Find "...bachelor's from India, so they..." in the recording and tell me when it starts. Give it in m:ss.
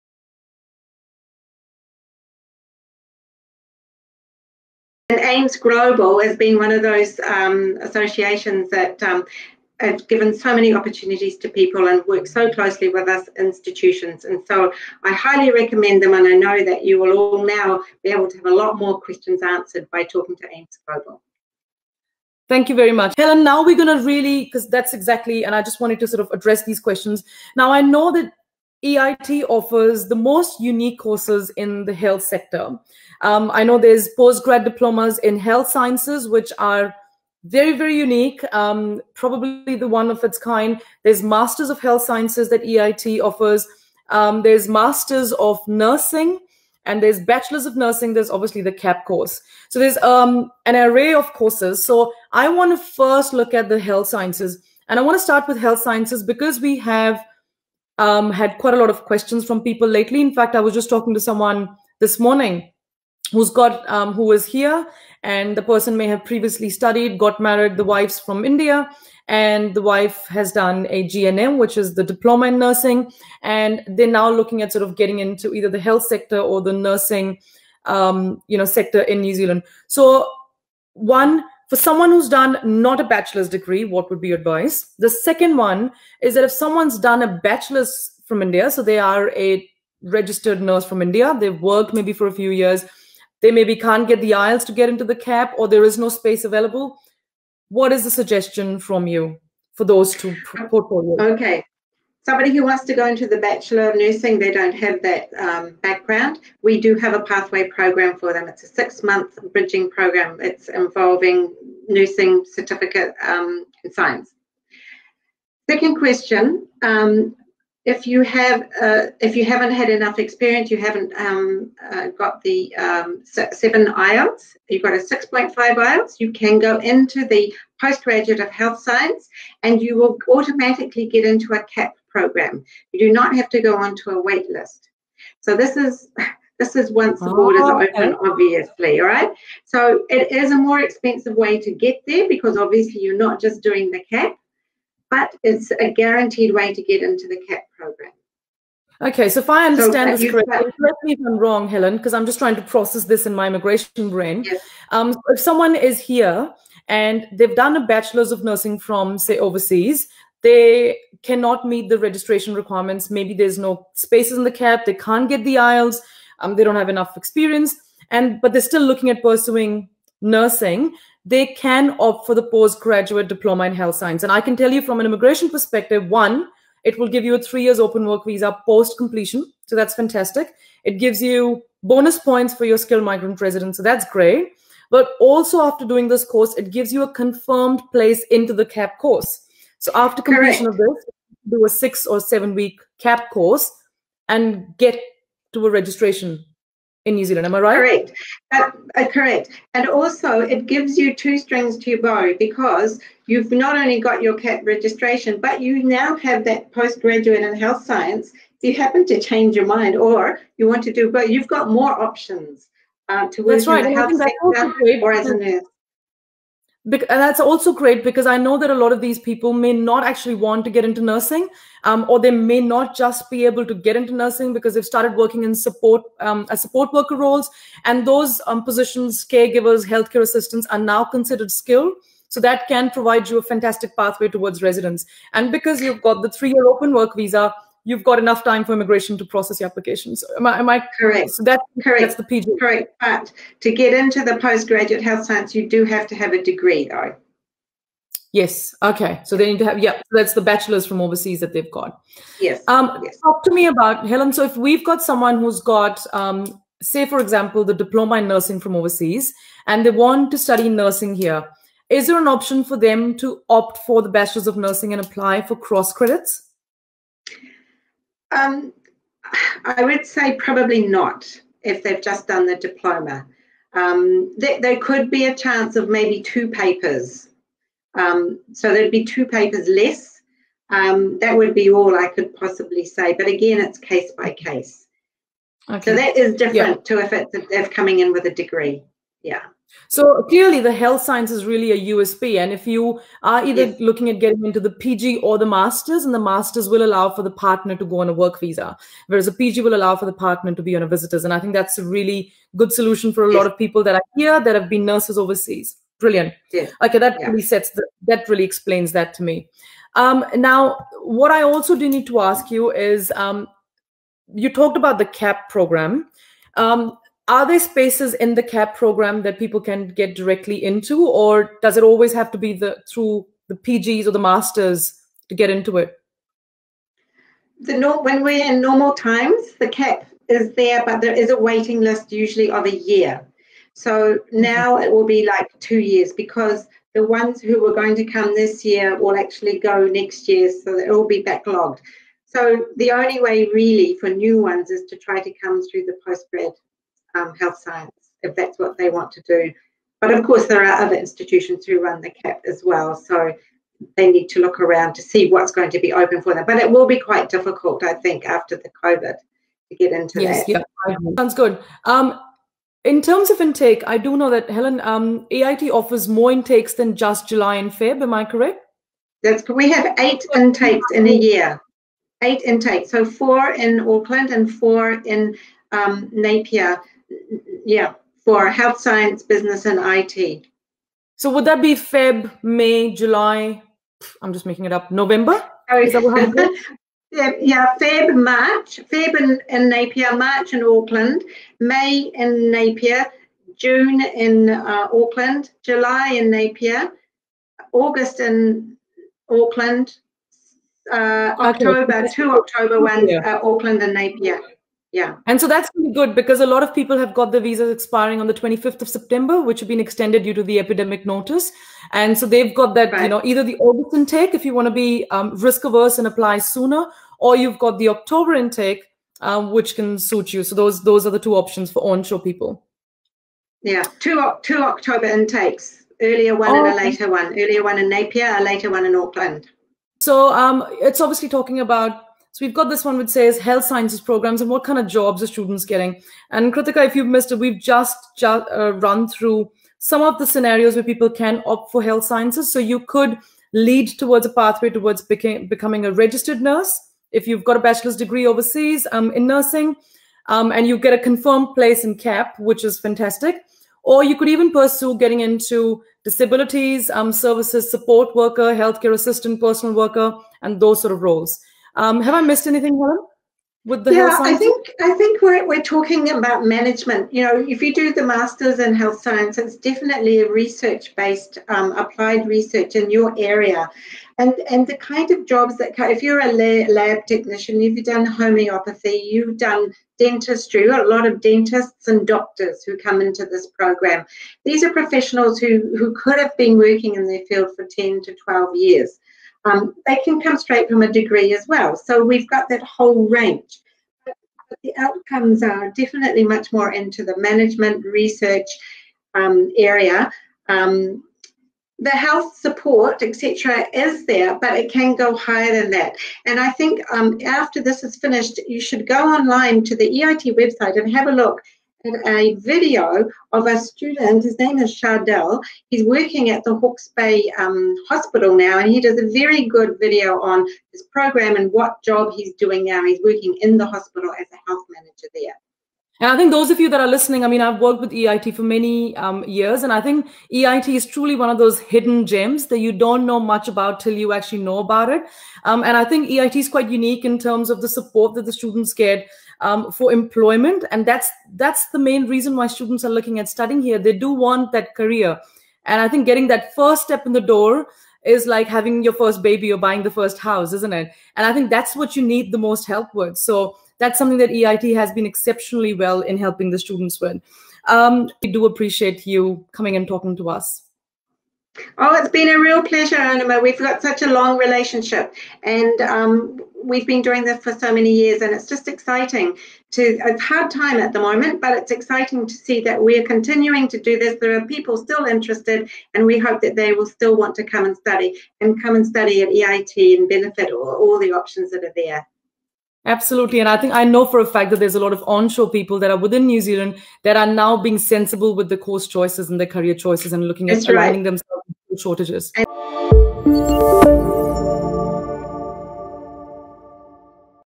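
1:27.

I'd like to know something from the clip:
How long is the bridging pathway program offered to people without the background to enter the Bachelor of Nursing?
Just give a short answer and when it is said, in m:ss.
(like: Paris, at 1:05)
6 months, at 1:48.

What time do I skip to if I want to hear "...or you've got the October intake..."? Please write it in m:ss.
6:57.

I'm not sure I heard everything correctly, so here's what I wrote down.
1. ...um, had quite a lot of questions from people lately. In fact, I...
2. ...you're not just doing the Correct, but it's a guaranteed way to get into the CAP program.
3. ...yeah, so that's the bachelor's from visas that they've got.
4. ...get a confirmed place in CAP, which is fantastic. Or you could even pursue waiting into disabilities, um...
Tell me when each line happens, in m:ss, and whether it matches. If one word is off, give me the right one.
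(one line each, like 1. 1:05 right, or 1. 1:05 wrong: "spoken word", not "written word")
1. 0:58 right
2. 2:23 wrong: "CAP", not "Correct"
3. 4:09 wrong: "overseas", not "visas"
4. 7:30 wrong: "getting", not "waiting".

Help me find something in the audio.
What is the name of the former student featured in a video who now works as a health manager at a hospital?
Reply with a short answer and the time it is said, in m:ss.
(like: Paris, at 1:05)
Shardell, at 8:34.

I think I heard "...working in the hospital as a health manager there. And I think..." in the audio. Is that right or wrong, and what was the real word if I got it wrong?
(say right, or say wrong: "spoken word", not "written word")
right.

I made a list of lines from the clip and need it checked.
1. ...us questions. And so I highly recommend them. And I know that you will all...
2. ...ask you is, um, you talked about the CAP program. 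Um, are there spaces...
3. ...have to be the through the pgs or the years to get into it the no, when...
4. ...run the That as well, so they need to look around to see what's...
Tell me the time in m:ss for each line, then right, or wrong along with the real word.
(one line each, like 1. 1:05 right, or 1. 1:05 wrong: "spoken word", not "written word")
1. 0:13 wrong: "institutions", not "questions"
2. 5:12 right
3. 5:22 wrong: "masters", not "years"
4. 5:51 wrong: "CAP", not "That".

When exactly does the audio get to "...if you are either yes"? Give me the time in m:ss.
4:52.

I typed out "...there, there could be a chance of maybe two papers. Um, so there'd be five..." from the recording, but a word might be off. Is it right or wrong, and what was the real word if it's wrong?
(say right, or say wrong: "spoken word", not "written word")
wrong: "two", not "five".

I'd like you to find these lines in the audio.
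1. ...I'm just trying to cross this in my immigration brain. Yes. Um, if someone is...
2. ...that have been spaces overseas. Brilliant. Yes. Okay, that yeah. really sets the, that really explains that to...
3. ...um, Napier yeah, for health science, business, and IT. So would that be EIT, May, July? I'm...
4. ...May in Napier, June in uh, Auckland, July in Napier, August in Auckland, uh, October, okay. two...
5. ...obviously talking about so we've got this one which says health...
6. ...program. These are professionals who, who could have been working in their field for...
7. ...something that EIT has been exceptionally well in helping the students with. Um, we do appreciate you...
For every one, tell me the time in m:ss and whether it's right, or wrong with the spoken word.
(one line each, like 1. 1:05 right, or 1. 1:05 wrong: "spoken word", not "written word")
1. 2:32 wrong: "process", not "cross"
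2. 5:04 wrong: "nurses", not "spaces"
3. 6:15 wrong: "Feb", not "EIT"
4. 6:31 right
5. 7:10 right
6. 8:03 right
7. 9:13 right.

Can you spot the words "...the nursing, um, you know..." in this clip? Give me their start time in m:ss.
1:16.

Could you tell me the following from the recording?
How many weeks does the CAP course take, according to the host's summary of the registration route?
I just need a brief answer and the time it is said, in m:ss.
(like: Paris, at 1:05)
6 or 7 weeks, at 3:11.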